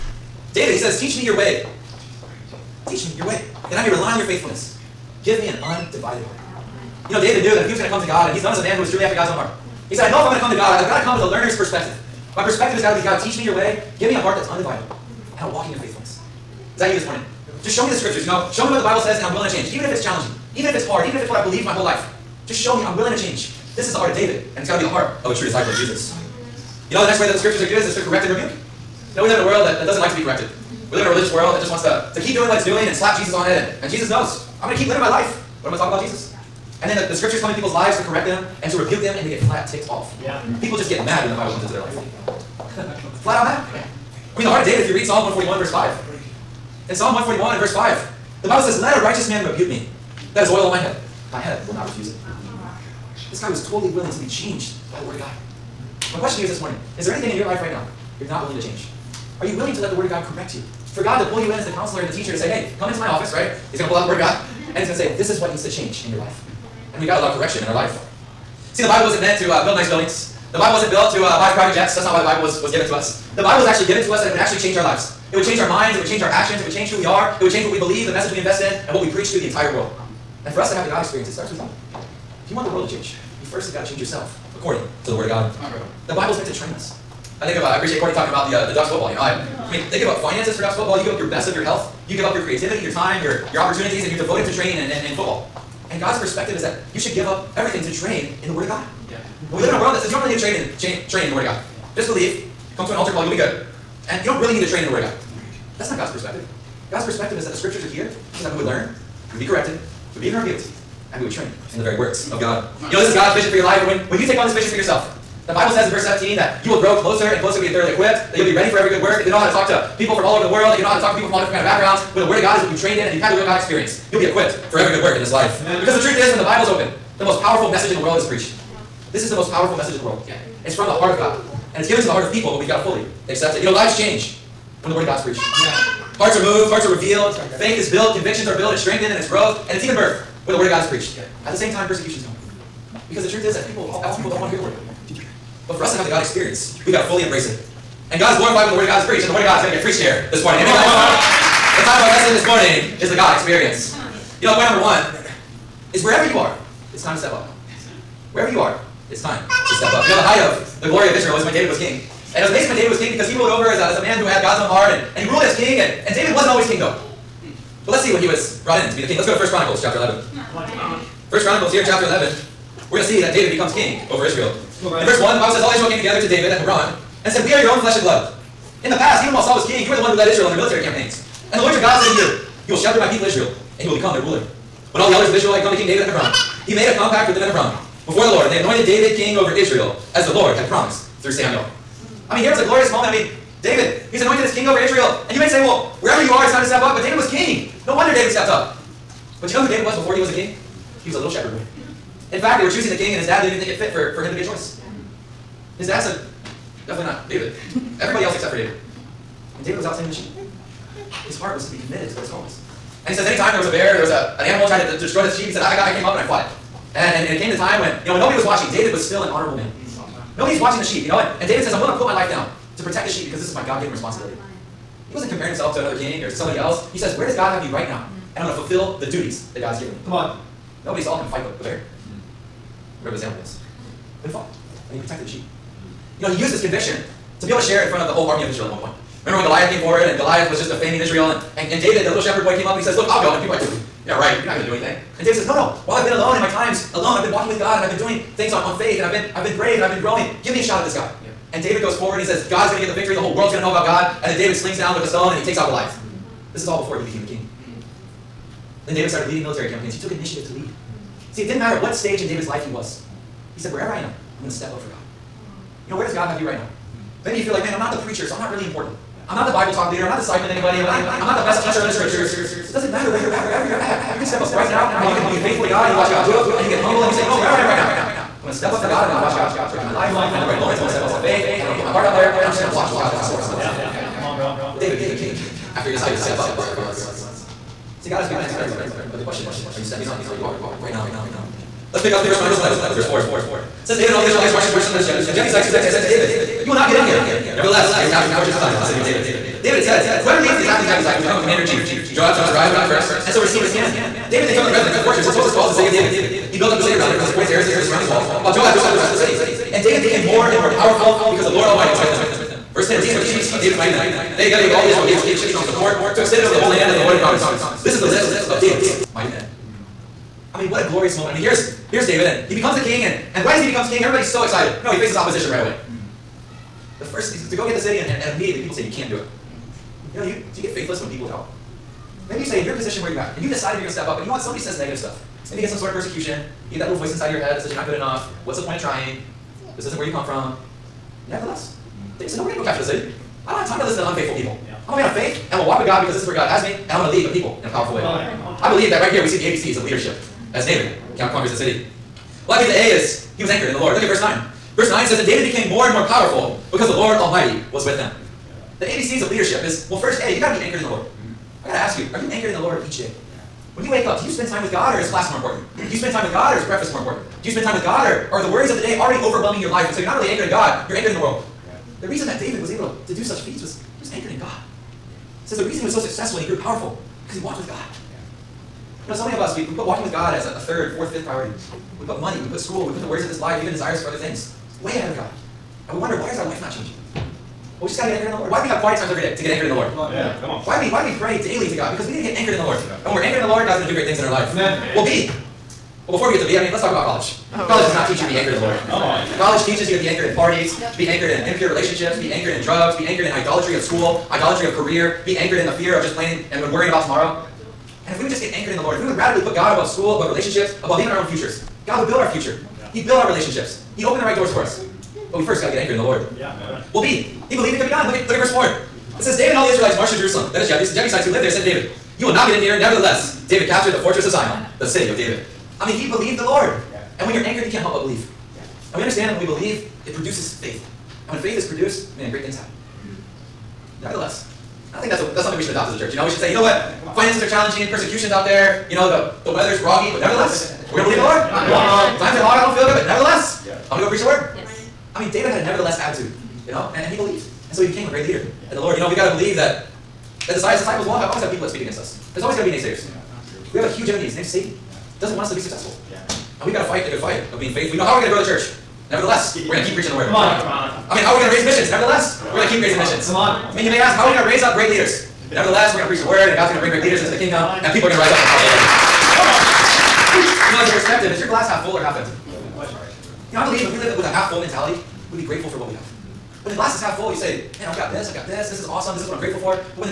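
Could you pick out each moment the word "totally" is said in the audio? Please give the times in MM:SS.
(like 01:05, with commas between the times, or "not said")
00:53.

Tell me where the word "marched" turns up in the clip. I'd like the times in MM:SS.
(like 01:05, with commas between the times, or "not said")
04:54, 06:59.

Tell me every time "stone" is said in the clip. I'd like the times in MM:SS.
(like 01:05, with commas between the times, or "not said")
04:15.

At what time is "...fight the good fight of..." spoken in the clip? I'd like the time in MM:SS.
07:36.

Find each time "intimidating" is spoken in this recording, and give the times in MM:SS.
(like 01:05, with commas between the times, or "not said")
not said.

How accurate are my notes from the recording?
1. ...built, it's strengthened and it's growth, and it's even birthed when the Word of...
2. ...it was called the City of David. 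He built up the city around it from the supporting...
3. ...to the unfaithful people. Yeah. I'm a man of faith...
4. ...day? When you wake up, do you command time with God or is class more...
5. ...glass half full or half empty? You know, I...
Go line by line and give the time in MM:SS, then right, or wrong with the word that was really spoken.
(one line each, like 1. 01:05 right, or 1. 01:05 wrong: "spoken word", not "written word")
1. 02:18 right
2. 05:05 right
3. 05:44 right
4. 06:02 wrong: "spend", not "command"
5. 07:51 right.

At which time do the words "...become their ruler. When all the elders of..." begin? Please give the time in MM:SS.
03:03.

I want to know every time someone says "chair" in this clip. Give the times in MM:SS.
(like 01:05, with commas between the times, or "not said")
not said.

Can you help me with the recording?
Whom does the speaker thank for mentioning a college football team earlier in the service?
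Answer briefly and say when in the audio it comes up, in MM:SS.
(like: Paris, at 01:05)
Courtney, at 01:28.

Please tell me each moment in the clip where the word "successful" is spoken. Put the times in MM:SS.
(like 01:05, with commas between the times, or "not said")
06:15, 07:35.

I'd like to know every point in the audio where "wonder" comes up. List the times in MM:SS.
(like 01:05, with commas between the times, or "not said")
03:17, 06:25.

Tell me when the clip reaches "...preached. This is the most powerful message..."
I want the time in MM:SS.
02:08.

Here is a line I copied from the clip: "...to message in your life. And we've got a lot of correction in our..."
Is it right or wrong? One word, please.
wrong.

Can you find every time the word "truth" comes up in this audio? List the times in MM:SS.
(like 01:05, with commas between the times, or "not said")
02:06, 02:23.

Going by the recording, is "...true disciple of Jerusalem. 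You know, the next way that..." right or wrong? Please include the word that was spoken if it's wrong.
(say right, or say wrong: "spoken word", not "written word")
wrong: "Jesus", not "Jerusalem".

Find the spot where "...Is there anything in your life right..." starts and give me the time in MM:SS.
00:56.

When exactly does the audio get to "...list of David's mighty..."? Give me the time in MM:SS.
05:18.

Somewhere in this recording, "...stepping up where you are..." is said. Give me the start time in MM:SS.
04:49.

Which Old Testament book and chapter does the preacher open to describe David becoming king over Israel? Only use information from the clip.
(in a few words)
1 Chronicles 11.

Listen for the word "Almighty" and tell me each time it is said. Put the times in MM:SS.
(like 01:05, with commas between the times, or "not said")
05:11, 05:57.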